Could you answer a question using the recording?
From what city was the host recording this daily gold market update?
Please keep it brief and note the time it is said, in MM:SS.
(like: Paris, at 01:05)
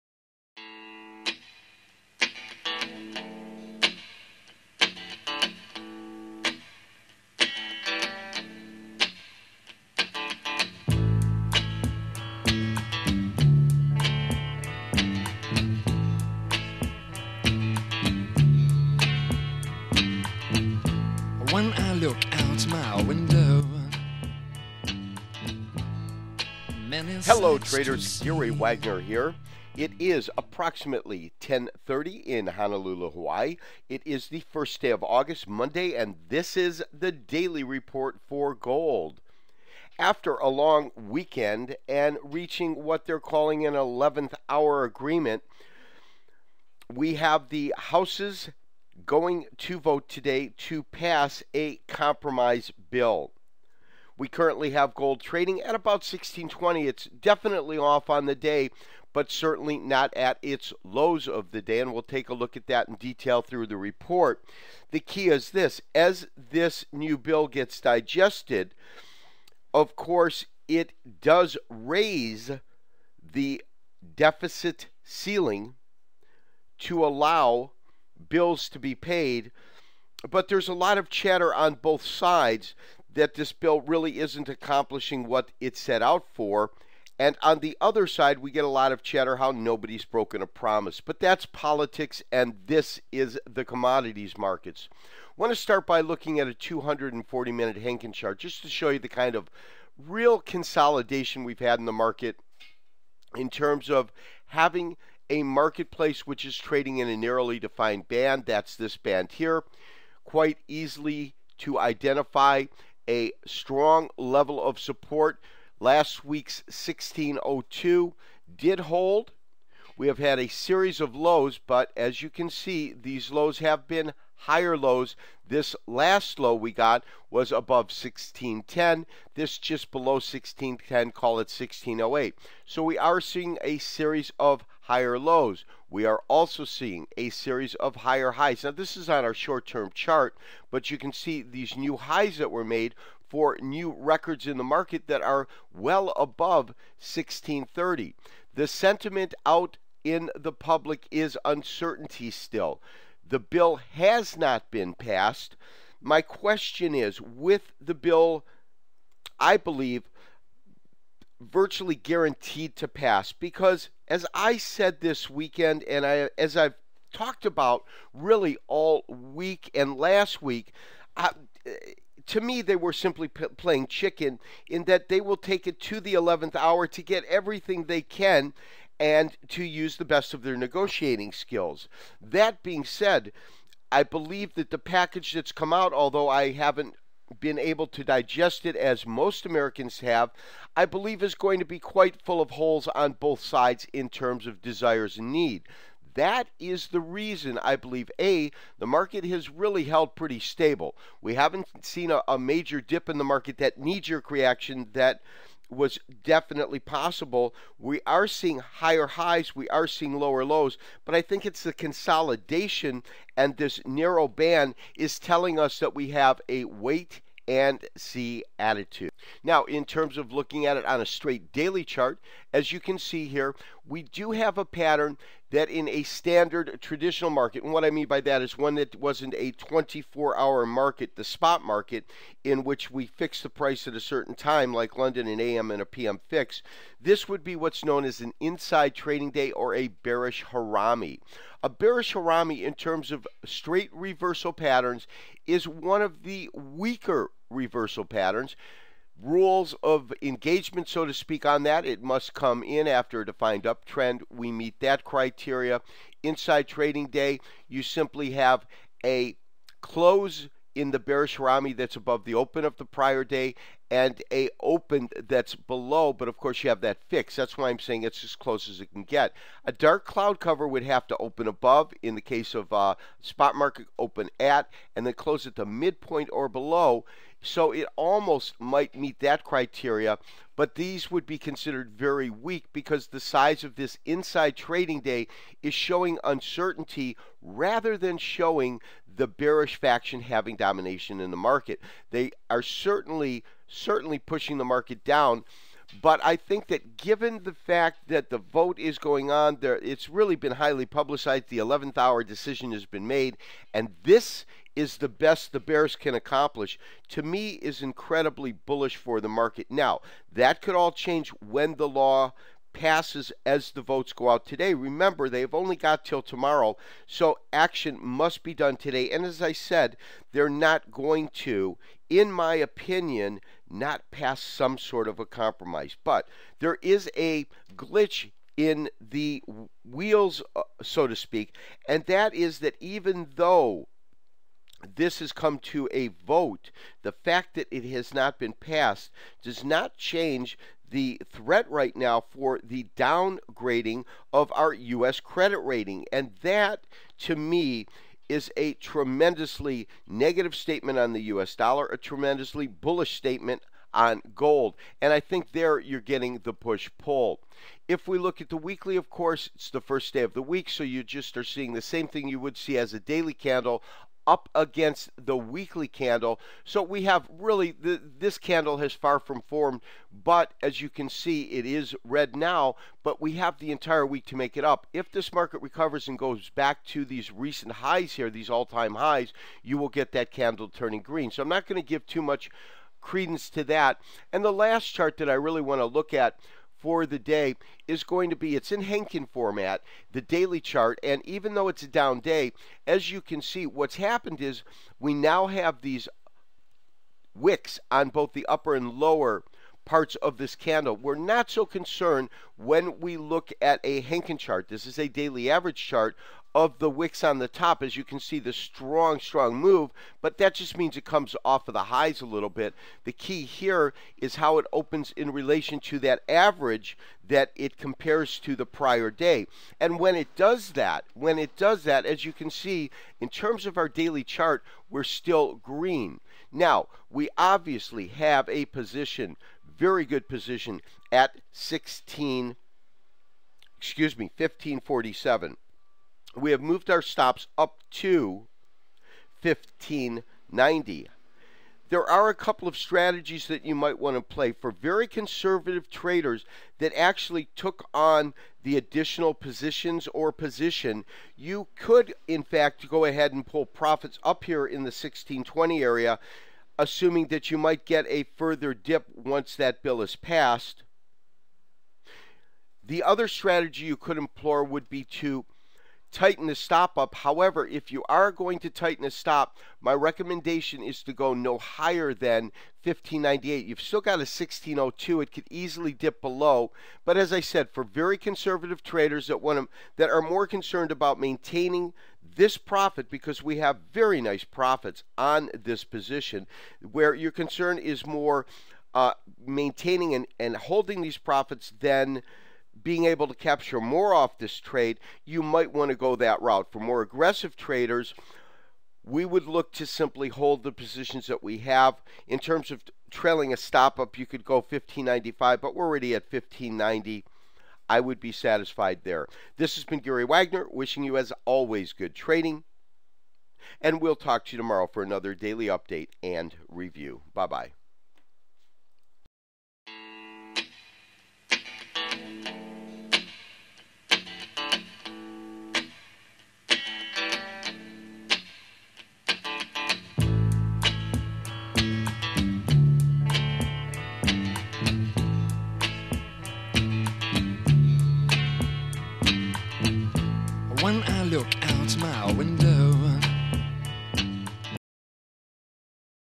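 Honolulu, at 00:32.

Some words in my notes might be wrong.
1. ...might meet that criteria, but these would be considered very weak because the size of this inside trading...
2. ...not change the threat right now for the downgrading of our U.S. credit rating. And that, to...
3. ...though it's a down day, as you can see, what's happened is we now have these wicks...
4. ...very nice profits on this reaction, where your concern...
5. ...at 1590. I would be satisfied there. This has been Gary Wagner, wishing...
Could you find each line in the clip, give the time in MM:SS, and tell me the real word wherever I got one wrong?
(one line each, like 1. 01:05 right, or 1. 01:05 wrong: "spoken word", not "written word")
1. 04:38 right
2. 05:39 right
3. 06:31 right
4. 08:03 wrong: "position", not "reaction"
5. 08:26 right.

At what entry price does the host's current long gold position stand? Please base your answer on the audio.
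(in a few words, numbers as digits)
1547.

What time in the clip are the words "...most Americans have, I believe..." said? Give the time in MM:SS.
03:09.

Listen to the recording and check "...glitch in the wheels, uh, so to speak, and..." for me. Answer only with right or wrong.
right.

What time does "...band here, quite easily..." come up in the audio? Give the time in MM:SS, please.
01:48.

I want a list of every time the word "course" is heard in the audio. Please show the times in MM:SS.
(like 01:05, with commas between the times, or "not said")
01:09, 04:26, 05:59.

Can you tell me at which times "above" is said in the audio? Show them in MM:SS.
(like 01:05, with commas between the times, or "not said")
02:07, 02:26, 04:21, 04:31.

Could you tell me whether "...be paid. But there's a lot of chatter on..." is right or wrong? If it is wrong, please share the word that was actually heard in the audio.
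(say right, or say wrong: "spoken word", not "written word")
right.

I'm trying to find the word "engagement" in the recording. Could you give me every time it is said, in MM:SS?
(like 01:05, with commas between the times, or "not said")
04:10.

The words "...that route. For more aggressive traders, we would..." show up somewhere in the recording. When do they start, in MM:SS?
08:16.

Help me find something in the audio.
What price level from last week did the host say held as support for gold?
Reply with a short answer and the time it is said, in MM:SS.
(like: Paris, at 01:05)
1602, at 01:55.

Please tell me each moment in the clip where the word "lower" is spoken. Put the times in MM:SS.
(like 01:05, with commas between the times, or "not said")
03:30, 06:38.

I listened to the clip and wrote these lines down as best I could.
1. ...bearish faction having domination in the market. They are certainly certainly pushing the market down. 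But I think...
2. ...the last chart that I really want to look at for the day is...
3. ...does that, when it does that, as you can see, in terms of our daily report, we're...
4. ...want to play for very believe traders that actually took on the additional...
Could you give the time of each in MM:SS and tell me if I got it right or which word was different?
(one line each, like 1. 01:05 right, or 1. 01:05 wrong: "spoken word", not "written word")
1. 04:49 right
2. 06:24 right
3. 07:00 wrong: "chart", not "report"
4. 07:23 wrong: "conservative", not "believe".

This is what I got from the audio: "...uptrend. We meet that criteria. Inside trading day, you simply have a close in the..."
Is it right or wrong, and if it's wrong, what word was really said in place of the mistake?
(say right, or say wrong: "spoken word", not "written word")
right.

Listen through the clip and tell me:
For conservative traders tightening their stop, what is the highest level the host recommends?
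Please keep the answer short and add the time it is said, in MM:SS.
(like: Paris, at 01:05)
1598, at 07:52.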